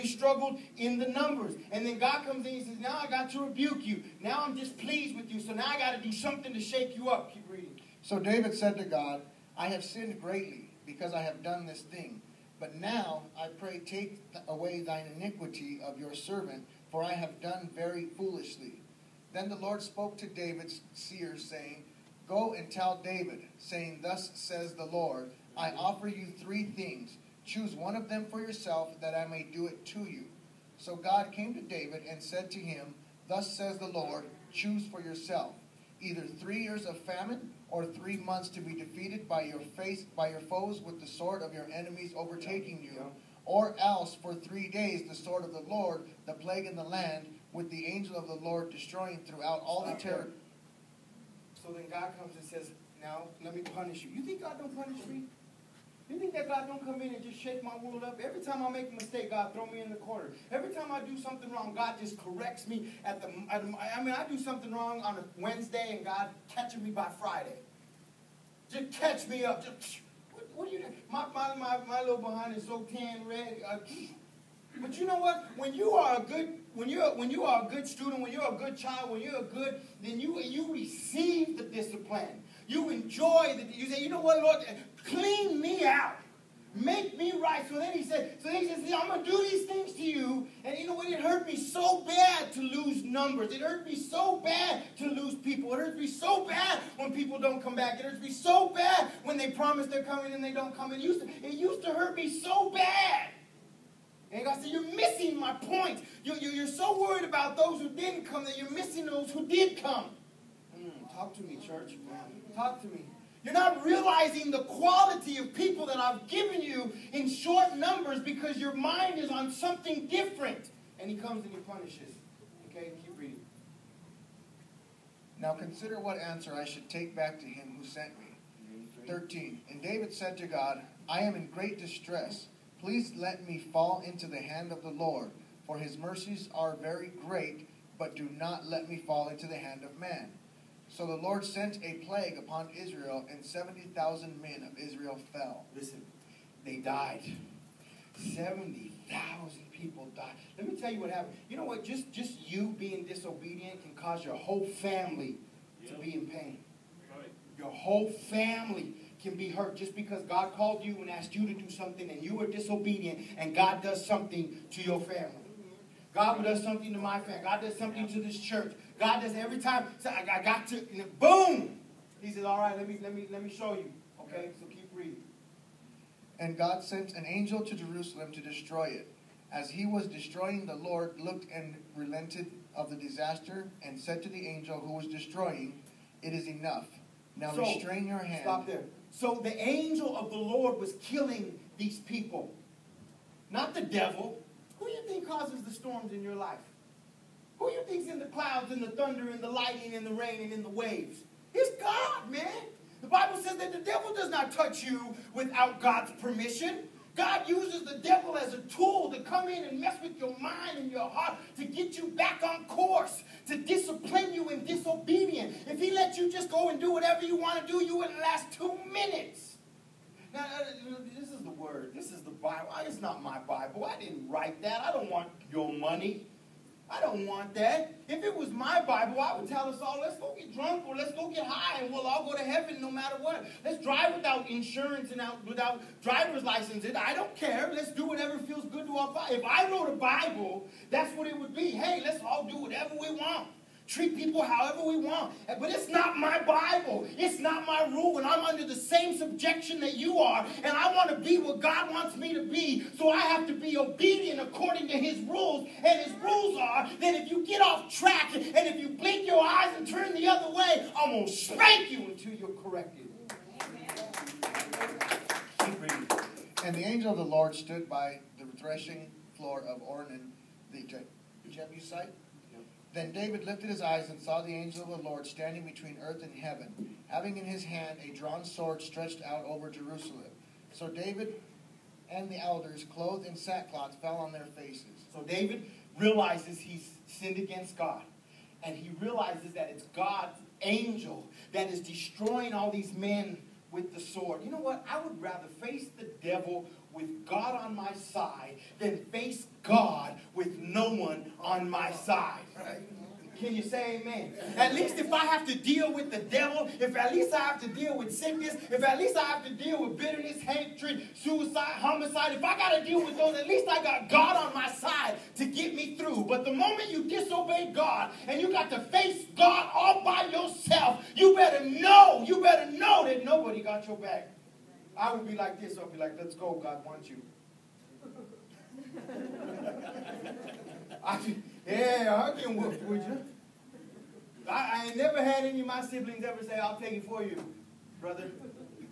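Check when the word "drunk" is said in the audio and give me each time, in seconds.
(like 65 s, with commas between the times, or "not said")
230 s.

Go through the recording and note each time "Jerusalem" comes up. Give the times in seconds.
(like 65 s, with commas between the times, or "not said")
177 s, 279 s.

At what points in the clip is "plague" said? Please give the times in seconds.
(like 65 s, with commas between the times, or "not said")
46 s, 142 s.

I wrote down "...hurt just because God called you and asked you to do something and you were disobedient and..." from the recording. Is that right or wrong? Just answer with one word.
right.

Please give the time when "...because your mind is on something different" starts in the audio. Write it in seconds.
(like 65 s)
118 s.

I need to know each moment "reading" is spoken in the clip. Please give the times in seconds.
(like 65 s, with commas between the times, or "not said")
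7 s, 123 s, 174 s.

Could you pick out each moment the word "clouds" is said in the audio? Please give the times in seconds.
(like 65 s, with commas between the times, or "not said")
198 s.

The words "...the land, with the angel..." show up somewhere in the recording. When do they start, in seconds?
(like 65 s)
46 s.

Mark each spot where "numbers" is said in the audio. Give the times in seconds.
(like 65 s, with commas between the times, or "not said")
1 s, 93 s, 117 s.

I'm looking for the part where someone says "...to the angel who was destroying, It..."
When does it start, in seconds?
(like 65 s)
184 s.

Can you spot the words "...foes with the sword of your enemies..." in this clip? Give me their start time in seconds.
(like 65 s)
40 s.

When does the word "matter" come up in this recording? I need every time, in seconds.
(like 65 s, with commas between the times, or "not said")
232 s.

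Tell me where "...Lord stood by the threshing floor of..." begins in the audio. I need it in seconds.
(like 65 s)
267 s.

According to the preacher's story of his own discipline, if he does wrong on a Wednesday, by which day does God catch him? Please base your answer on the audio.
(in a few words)
Friday.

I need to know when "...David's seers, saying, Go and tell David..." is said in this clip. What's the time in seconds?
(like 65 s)
20 s.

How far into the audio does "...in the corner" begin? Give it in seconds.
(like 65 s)
59 s.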